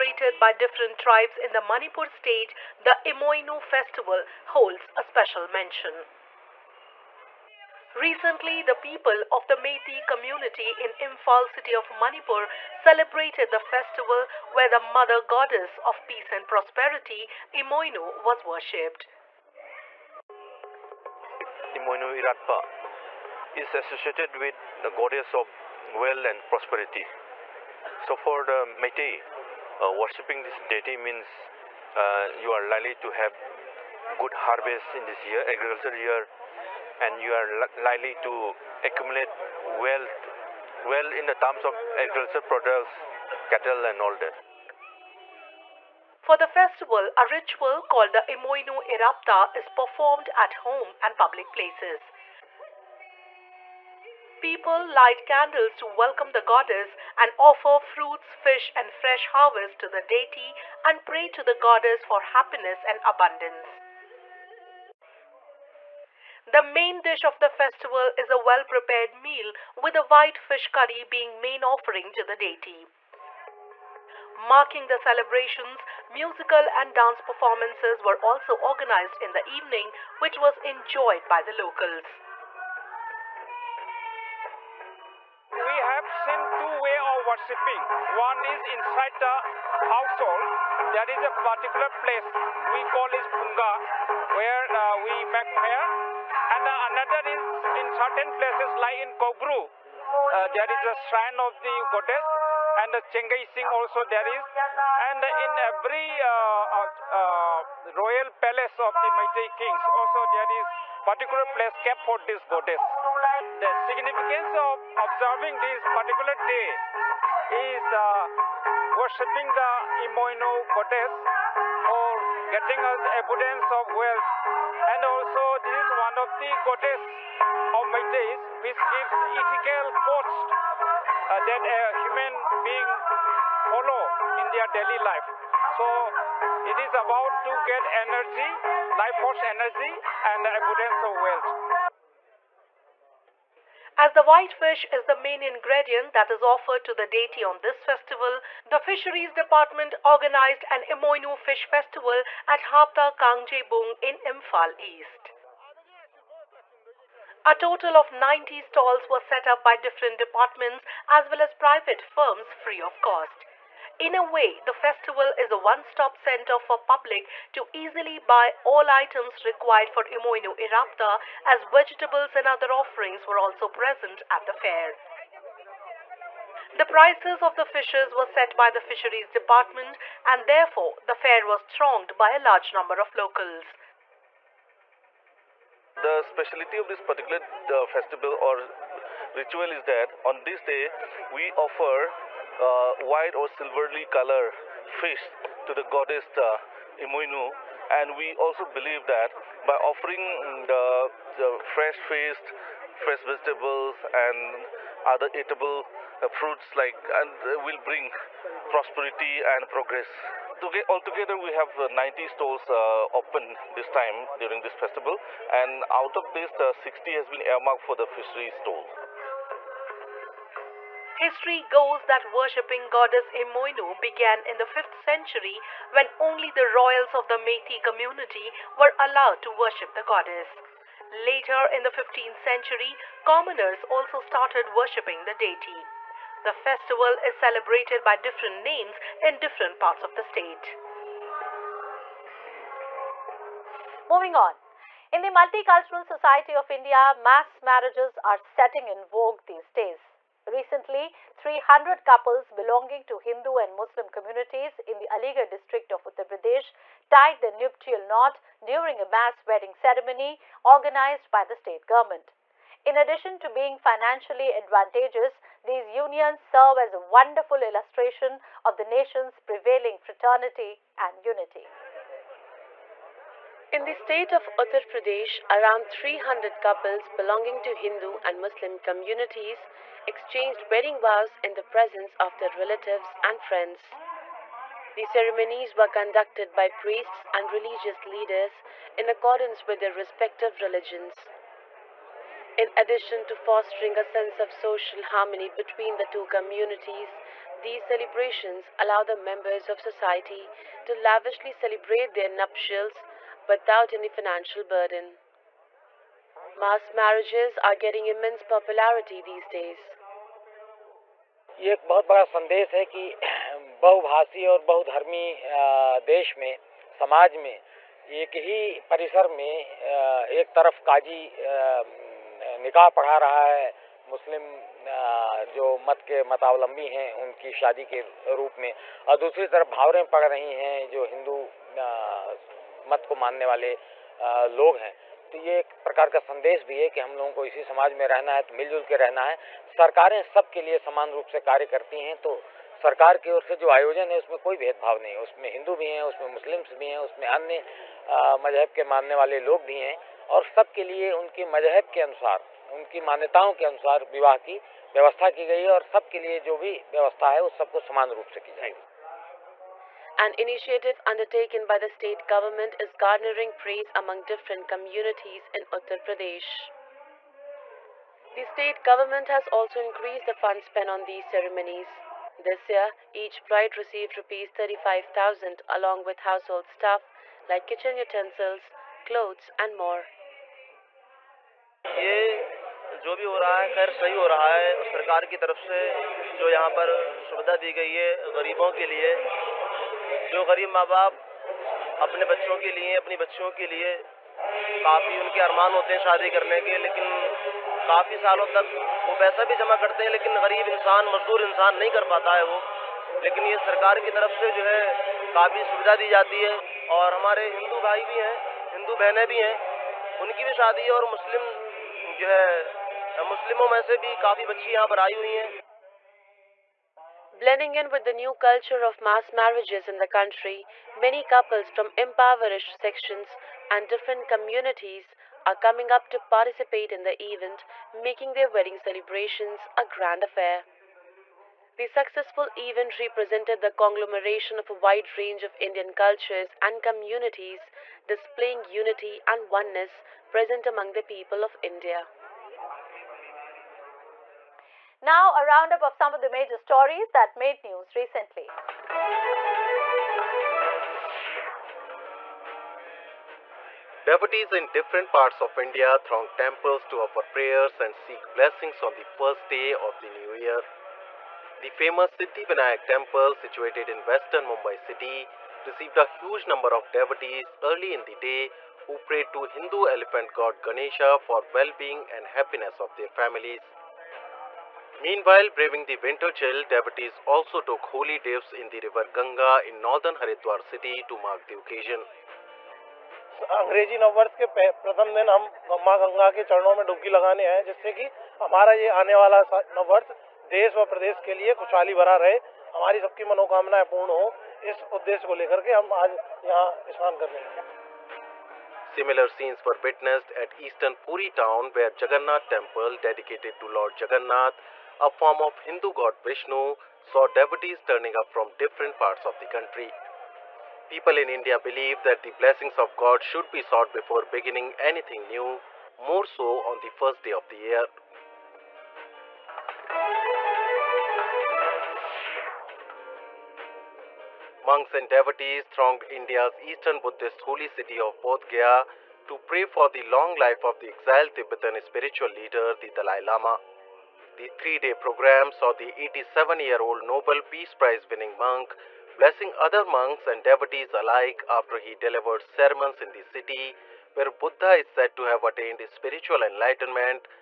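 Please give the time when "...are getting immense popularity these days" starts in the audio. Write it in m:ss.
5:07.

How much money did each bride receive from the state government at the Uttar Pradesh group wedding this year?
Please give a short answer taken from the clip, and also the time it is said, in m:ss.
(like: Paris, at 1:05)
Rs 35,000, at 6:14.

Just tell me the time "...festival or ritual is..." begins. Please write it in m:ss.
3:07.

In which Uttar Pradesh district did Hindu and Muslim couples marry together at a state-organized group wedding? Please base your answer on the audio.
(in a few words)
Aligarh.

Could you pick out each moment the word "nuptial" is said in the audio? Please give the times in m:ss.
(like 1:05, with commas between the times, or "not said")
4:17, 5:02.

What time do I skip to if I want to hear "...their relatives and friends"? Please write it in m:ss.
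4:42.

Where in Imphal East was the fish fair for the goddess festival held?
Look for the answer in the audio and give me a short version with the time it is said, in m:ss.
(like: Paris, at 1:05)
Hapta Kangjebung, at 2:32.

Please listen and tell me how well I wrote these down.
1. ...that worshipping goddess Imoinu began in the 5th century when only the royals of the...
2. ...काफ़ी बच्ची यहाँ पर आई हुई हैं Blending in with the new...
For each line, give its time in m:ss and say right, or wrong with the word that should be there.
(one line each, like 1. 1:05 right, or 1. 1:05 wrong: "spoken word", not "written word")
1. 3:42 right
2. 6:54 right.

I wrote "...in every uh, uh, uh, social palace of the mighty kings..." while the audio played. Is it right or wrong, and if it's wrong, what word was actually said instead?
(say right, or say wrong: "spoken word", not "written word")
wrong: "royal", not "social".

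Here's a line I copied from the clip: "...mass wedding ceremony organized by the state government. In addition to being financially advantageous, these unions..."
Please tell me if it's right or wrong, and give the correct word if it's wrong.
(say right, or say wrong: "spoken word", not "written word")
right.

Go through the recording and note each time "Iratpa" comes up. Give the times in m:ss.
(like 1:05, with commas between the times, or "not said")
0:22, 0:48, 2:50.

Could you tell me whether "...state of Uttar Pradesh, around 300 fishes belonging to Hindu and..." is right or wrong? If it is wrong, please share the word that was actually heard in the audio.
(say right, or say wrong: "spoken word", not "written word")
wrong: "couples", not "fishes".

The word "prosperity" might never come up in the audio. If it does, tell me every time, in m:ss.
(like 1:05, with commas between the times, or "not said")
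0:16, 0:26, 3:28.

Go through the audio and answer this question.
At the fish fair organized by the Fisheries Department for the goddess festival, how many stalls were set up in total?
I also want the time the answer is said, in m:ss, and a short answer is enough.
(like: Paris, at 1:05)
90, at 2:38.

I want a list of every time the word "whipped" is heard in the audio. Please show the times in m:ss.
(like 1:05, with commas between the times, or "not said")
not said.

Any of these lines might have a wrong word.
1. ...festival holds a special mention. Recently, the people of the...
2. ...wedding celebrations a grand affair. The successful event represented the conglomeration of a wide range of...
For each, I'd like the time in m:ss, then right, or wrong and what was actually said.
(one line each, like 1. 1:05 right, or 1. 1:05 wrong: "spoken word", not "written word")
1. 0:03 right
2. 7:08 right.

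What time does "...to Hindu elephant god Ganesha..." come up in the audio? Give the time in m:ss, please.
7:49.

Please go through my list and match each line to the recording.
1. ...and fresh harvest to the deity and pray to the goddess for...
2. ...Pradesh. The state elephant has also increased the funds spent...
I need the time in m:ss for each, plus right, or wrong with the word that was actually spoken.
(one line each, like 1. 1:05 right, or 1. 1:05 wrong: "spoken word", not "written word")
1. 0:58 right
2. 6:06 wrong: "government", not "elephant".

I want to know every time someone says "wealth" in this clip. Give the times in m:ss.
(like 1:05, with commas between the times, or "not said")
0:25, 0:39, 2:03, 2:21.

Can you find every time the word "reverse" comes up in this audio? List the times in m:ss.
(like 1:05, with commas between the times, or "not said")
not said.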